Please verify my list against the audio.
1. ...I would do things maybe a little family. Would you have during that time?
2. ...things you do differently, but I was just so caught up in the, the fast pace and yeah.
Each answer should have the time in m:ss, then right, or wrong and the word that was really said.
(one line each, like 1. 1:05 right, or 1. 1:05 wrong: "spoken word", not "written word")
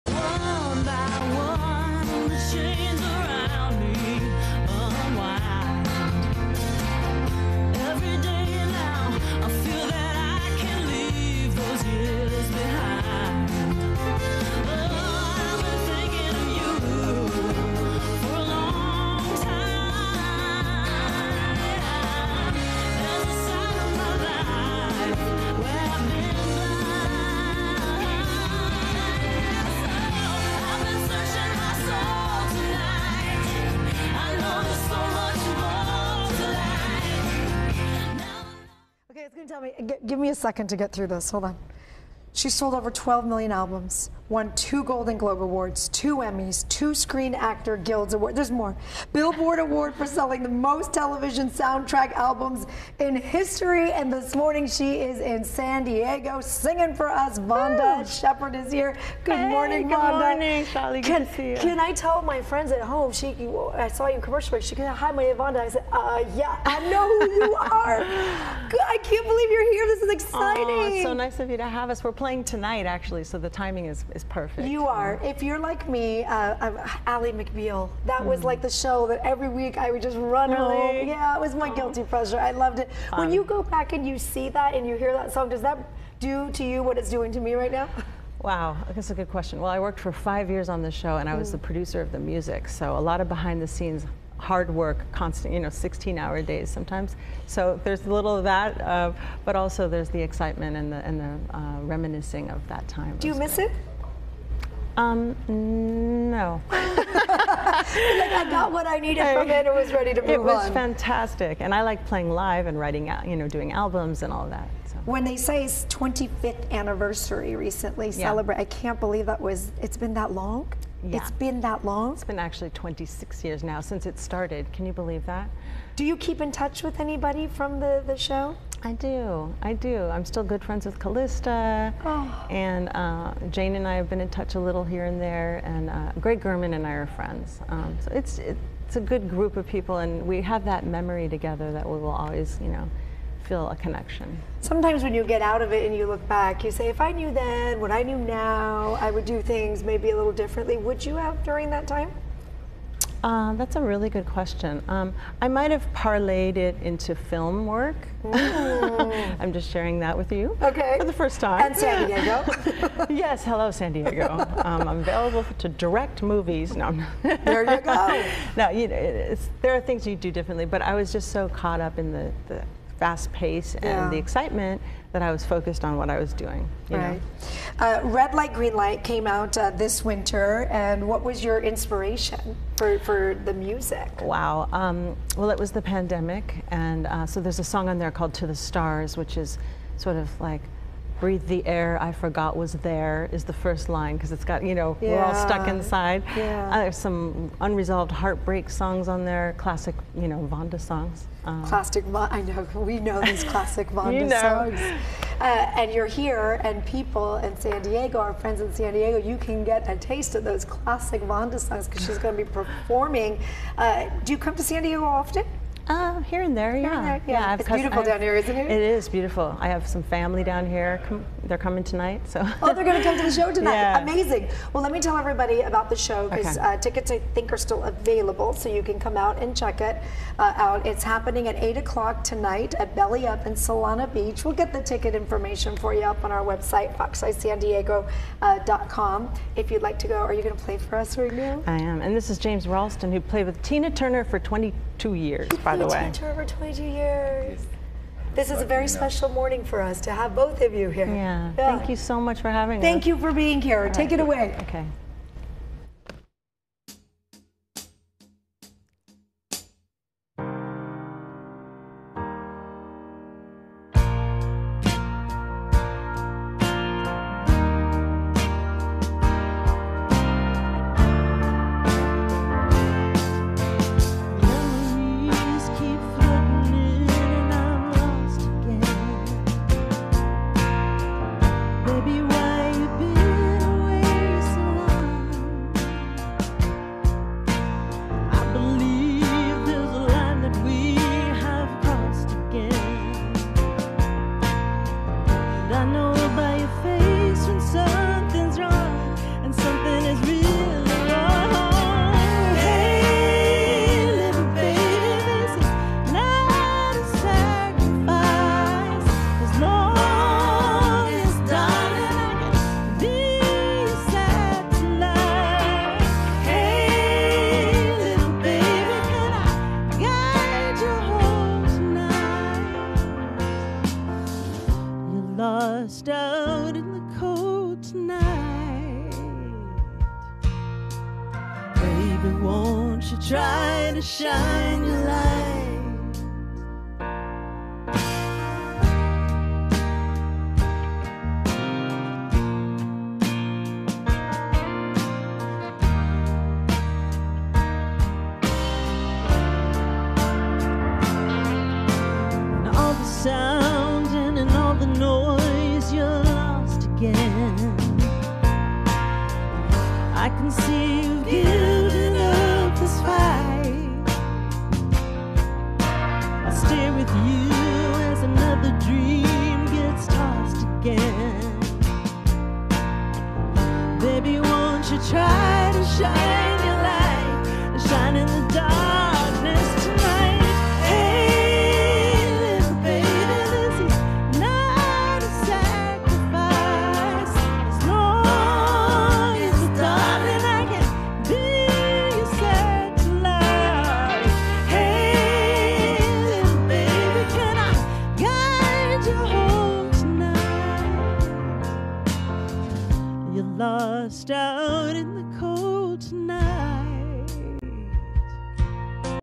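1. 2:29 wrong: "differently", not "family"
2. 2:49 right.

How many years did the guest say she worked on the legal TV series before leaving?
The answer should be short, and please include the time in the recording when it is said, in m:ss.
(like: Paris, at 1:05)
5, at 1:30.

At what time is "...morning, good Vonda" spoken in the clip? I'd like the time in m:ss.
0:59.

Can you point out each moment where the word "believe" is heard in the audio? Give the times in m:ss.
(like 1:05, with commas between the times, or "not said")
1:09, 1:58, 2:04.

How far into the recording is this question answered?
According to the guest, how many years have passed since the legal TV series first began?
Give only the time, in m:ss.
2:02.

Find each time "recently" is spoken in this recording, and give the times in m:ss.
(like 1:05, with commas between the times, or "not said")
1:57.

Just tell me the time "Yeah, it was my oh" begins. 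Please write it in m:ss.
1:21.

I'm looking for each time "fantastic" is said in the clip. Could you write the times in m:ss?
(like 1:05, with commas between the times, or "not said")
1:50.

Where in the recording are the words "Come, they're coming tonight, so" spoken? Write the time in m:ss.
3:41.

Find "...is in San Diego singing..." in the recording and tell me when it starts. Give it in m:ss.
0:54.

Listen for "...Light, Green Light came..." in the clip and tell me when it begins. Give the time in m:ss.
2:58.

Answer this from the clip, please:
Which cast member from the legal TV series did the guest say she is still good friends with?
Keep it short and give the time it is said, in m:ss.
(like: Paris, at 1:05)
Calista, at 2:10.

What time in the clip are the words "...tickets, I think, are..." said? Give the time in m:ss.
3:46.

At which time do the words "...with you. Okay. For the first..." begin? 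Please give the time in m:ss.
2:40.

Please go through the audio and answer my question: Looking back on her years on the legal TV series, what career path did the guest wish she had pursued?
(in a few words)
Film work.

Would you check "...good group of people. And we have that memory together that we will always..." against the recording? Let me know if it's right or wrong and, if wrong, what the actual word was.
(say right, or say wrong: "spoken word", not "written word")
right.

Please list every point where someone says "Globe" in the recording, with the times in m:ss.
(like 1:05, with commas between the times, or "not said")
0:45.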